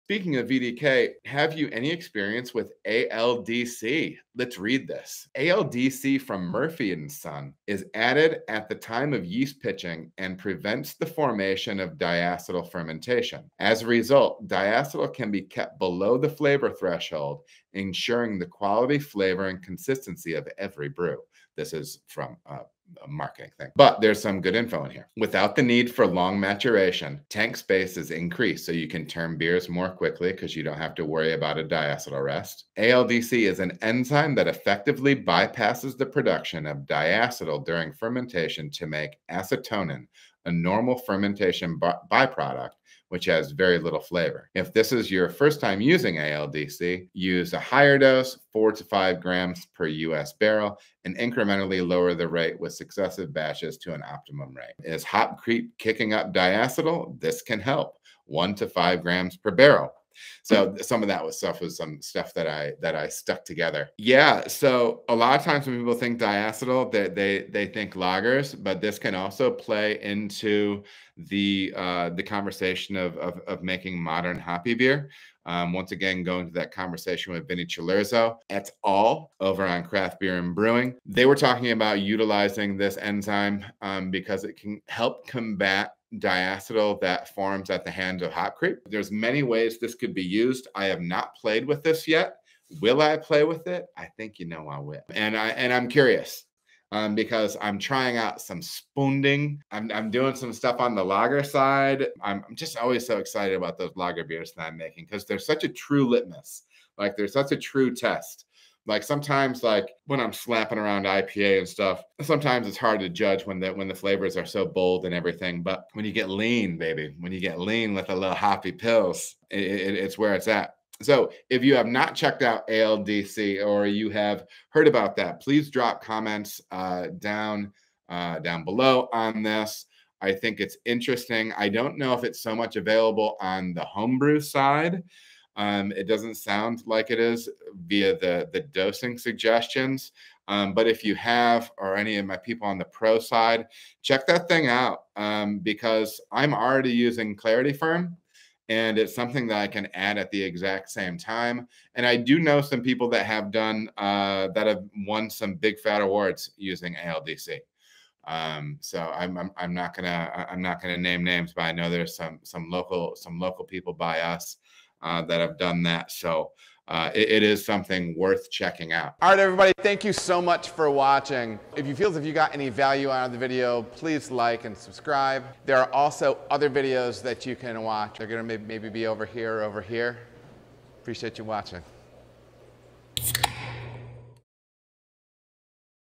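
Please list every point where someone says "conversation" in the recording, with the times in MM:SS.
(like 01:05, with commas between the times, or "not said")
01:12, 01:16.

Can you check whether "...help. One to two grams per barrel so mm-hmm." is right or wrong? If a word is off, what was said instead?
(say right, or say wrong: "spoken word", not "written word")
wrong: "five", not "two".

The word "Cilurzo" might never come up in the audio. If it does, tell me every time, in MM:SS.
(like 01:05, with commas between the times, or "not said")
01:17.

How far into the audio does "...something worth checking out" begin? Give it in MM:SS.
02:47.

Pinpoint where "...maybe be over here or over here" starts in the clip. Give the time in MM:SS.
02:58.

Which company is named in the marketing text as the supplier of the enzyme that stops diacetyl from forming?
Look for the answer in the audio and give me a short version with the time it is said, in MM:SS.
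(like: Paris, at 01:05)
Murphy and Son, at 00:06.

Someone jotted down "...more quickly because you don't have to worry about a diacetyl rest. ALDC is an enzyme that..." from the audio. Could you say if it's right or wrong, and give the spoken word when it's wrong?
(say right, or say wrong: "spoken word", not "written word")
right.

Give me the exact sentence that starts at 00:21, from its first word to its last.
This is from uh, marketing thing.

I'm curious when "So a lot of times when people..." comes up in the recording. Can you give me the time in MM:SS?
01:04.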